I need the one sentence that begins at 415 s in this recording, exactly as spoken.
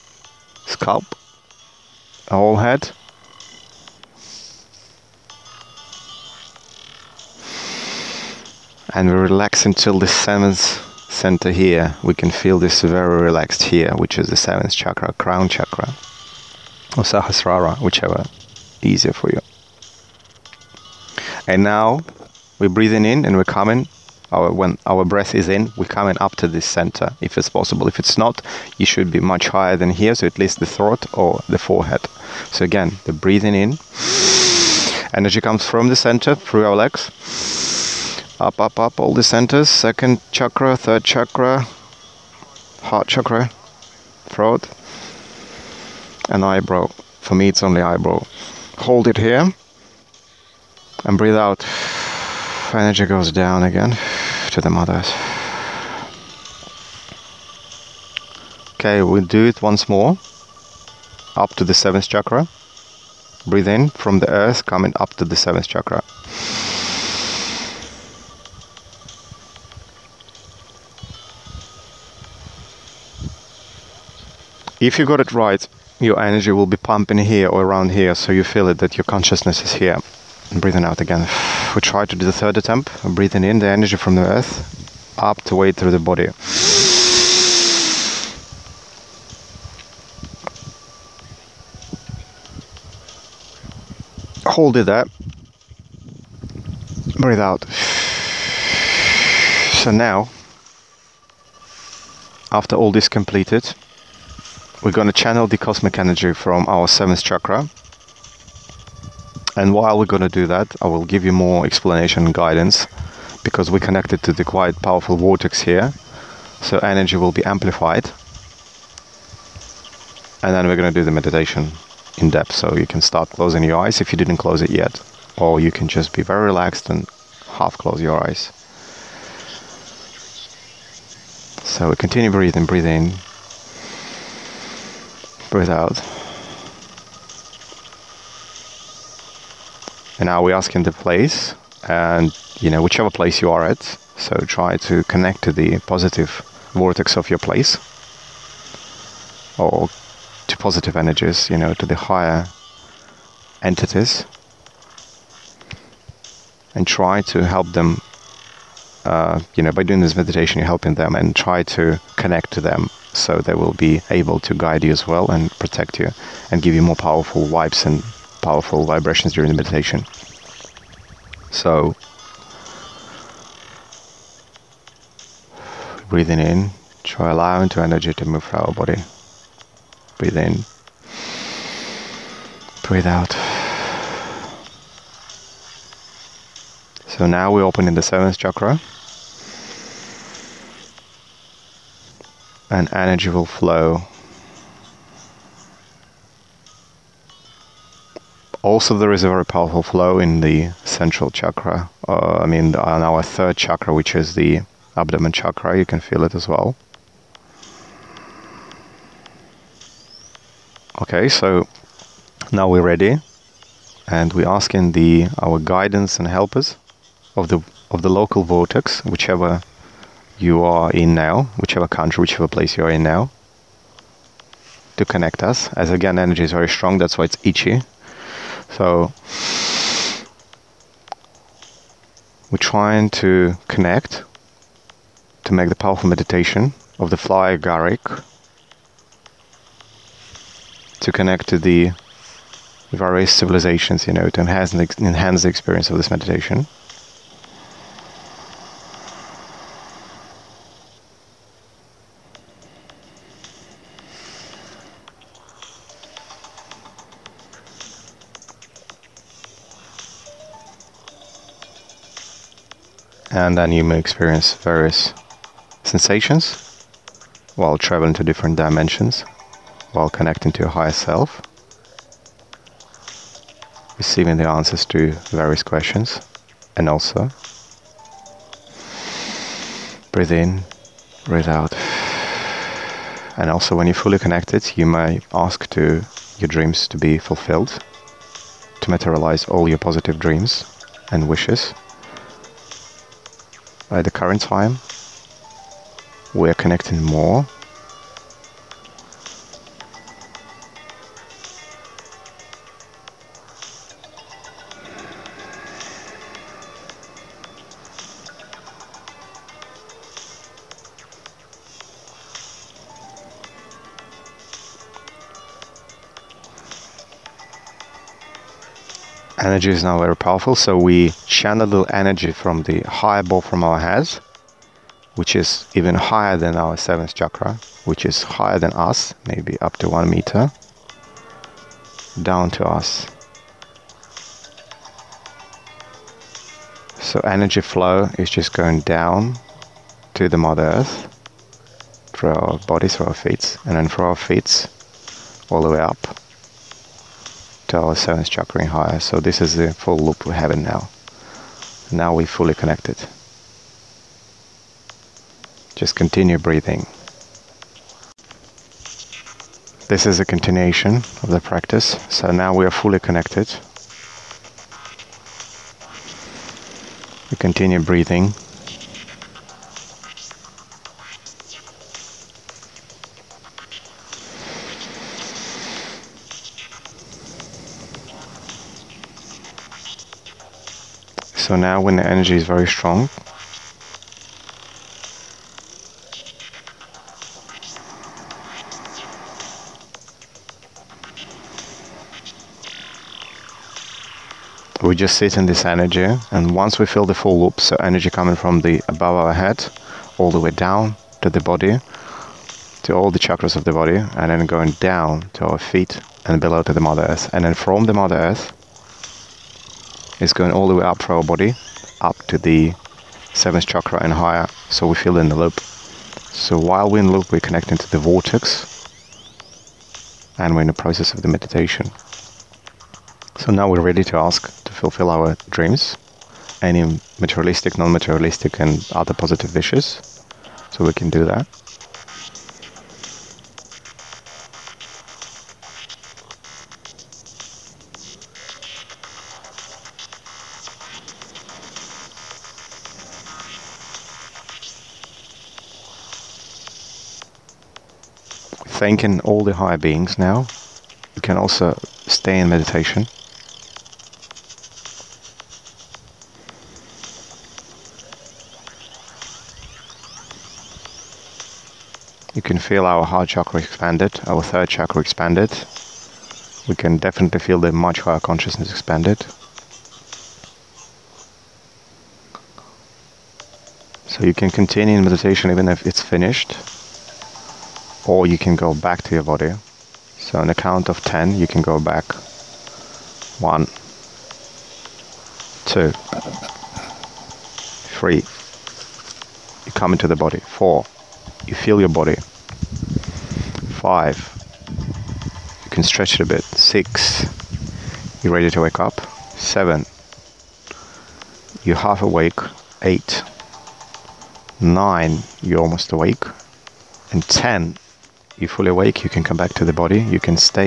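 So while we're in the loop, we're connecting to the vortex, and we're in the process of the meditation.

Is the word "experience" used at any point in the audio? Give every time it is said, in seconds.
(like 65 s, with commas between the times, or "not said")
245 s, 263 s.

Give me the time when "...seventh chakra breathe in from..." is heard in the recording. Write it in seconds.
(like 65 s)
61 s.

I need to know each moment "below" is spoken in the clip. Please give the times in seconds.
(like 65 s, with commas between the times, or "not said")
406 s.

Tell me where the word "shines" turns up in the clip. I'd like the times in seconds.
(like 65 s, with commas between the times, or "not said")
not said.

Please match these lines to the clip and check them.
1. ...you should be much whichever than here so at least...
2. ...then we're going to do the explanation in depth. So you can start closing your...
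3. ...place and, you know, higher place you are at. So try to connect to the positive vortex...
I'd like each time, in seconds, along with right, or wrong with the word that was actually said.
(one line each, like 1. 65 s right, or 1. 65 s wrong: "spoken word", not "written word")
1. 28 s wrong: "higher", not "whichever"
2. 120 s wrong: "meditation", not "explanation"
3. 140 s wrong: "whichever", not "higher".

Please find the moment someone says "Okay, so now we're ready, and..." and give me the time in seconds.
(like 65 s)
210 s.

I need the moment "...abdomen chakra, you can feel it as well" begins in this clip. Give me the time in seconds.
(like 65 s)
204 s.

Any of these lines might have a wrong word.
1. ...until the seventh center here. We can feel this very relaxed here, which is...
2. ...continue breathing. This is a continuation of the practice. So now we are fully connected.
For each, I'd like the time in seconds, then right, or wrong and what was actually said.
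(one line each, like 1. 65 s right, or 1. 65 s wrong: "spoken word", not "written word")
1. 9 s right
2. 355 s right.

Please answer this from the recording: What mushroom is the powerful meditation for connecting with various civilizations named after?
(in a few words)
fly agaric.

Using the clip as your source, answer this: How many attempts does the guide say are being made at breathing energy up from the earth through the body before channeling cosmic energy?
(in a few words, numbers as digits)
3.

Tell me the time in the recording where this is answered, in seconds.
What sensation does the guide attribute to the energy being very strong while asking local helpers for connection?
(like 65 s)
227 s.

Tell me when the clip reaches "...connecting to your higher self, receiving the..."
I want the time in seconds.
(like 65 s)
270 s.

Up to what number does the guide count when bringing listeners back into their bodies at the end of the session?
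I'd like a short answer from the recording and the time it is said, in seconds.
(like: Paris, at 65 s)
10, at 480 s.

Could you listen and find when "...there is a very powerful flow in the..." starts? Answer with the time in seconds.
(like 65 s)
198 s.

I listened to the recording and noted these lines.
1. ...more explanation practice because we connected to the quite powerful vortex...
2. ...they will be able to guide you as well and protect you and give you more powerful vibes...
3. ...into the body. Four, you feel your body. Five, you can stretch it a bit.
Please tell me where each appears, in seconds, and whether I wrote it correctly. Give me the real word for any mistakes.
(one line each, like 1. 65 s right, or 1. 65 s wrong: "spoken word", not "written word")
1. 111 s wrong: "guidance", not "practice"
2. 163 s right
3. 489 s right.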